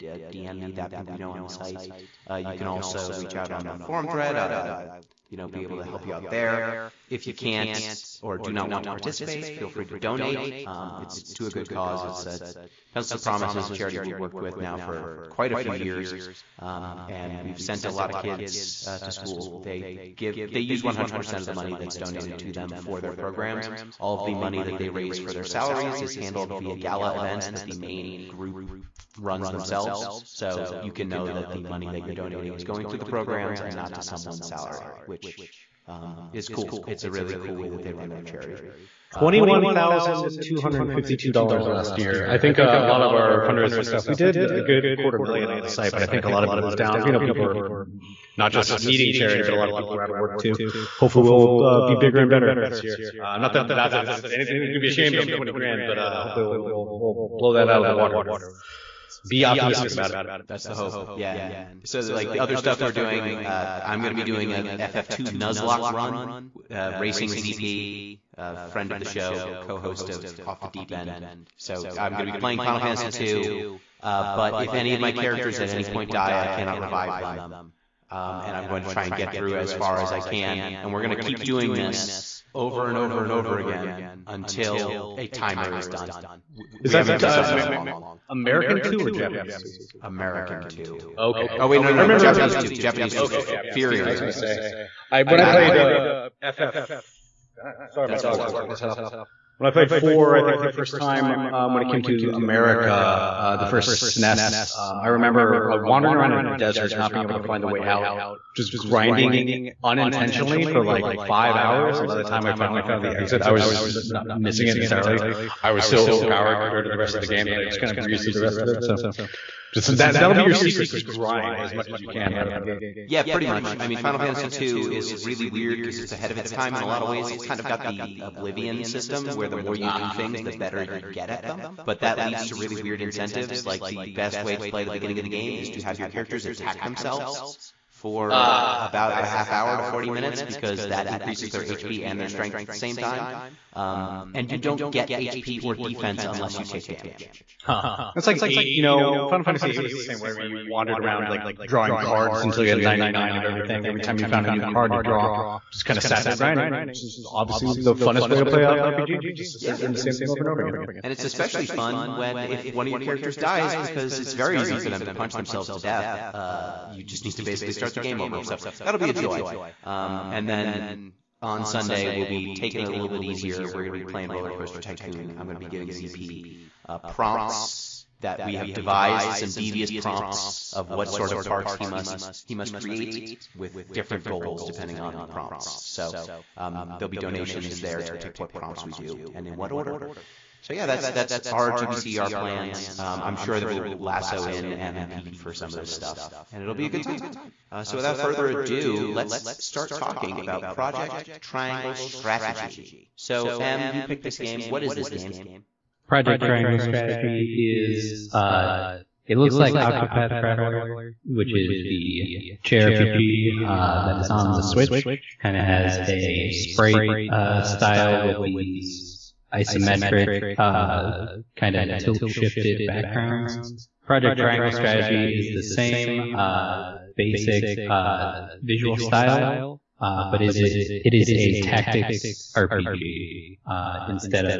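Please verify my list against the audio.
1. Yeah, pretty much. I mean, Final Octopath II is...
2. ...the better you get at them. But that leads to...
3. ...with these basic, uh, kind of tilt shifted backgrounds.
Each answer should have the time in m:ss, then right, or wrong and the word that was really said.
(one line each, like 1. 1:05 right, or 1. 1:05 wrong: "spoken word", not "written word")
1. 2:03 wrong: "Fantasy", not "Octopath"
2. 2:10 right
3. 3:38 wrong: "isometric", not "basic".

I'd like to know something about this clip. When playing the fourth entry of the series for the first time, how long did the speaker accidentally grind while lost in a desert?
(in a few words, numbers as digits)
5 hours.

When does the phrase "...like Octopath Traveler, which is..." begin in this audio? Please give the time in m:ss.
3:29.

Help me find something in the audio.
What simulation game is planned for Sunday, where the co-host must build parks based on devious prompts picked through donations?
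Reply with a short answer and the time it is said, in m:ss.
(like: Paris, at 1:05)
Roller Coaster Tycoon, at 2:54.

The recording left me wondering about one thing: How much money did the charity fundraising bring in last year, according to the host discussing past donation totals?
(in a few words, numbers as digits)
$21,252.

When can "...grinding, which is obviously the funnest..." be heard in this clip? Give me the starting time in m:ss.
2:36.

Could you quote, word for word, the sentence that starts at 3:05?
So um, there'll be donations there to pick what prompts we do and in what order.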